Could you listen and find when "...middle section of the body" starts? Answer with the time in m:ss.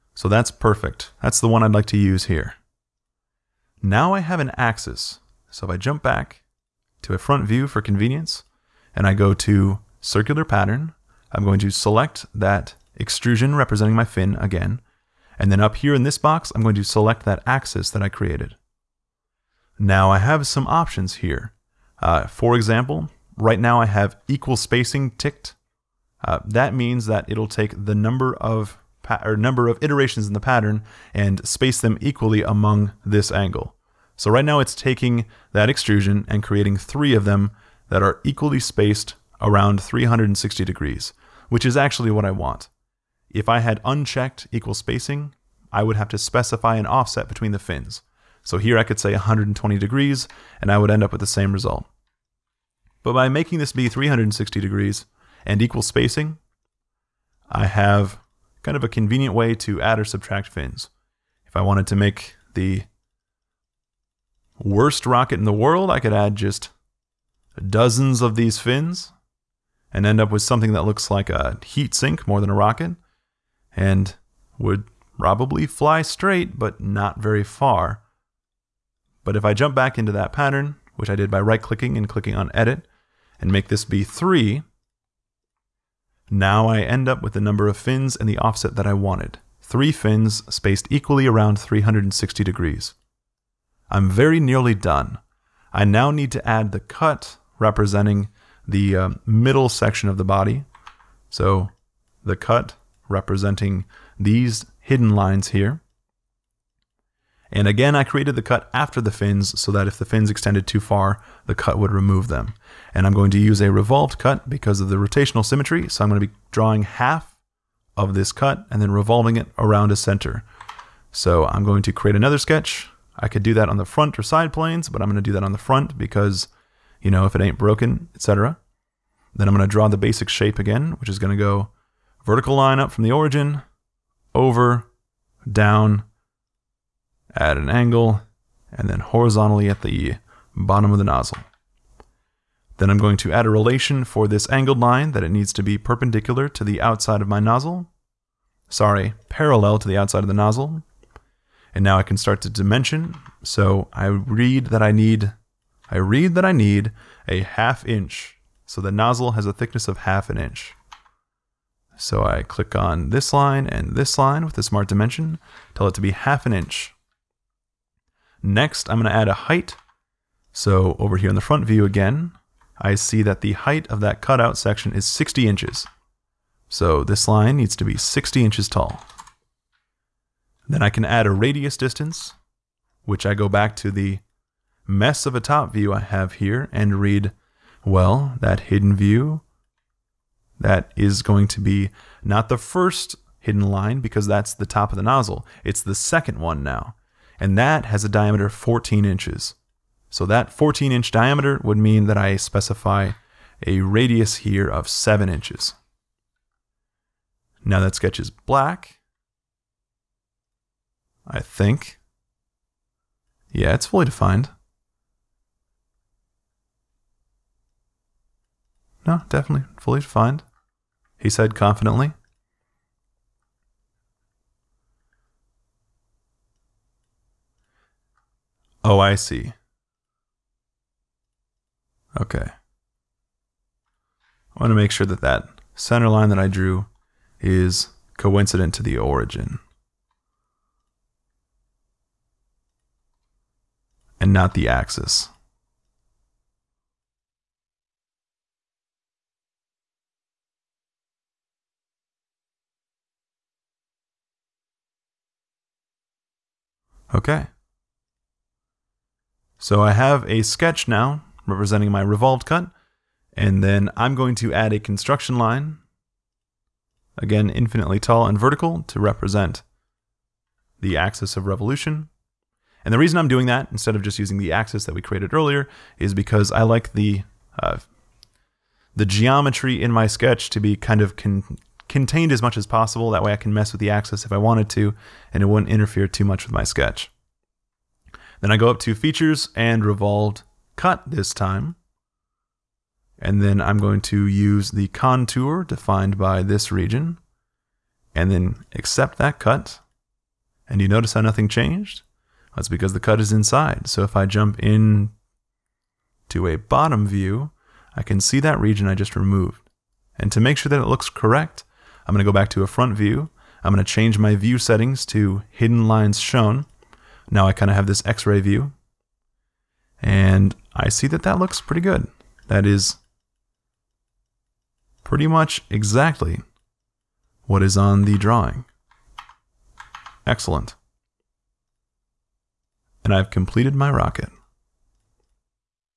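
1:39.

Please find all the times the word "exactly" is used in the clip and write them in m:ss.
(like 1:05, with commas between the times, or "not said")
5:25.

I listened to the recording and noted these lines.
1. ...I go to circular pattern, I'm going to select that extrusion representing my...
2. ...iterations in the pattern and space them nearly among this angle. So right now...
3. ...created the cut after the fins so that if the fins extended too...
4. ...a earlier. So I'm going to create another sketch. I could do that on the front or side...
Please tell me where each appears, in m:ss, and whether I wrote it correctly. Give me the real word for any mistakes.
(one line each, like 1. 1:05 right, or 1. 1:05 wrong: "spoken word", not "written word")
1. 0:09 right
2. 0:29 wrong: "equally", not "nearly"
3. 1:48 right
4. 1:59 wrong: "center", not "earlier".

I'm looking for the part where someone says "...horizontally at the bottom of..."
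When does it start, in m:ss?
2:18.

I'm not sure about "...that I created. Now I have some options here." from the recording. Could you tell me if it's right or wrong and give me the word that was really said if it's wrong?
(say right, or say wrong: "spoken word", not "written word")
right.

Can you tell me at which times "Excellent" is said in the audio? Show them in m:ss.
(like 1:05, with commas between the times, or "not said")
5:30.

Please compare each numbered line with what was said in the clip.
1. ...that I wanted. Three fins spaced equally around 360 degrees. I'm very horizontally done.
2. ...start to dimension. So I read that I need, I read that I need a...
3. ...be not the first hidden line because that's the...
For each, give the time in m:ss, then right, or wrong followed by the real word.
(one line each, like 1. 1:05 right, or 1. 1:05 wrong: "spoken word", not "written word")
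1. 1:28 wrong: "nearly", not "horizontally"
2. 2:32 right
3. 3:11 right.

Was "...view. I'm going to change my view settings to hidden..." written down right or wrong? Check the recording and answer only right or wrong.
right.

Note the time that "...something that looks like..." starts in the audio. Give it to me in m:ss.
1:10.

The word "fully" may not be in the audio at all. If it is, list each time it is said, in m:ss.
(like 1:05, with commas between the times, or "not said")
3:33, 3:39.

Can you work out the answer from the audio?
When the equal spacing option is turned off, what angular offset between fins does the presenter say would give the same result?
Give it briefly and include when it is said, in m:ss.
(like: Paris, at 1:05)
120 degrees, at 0:49.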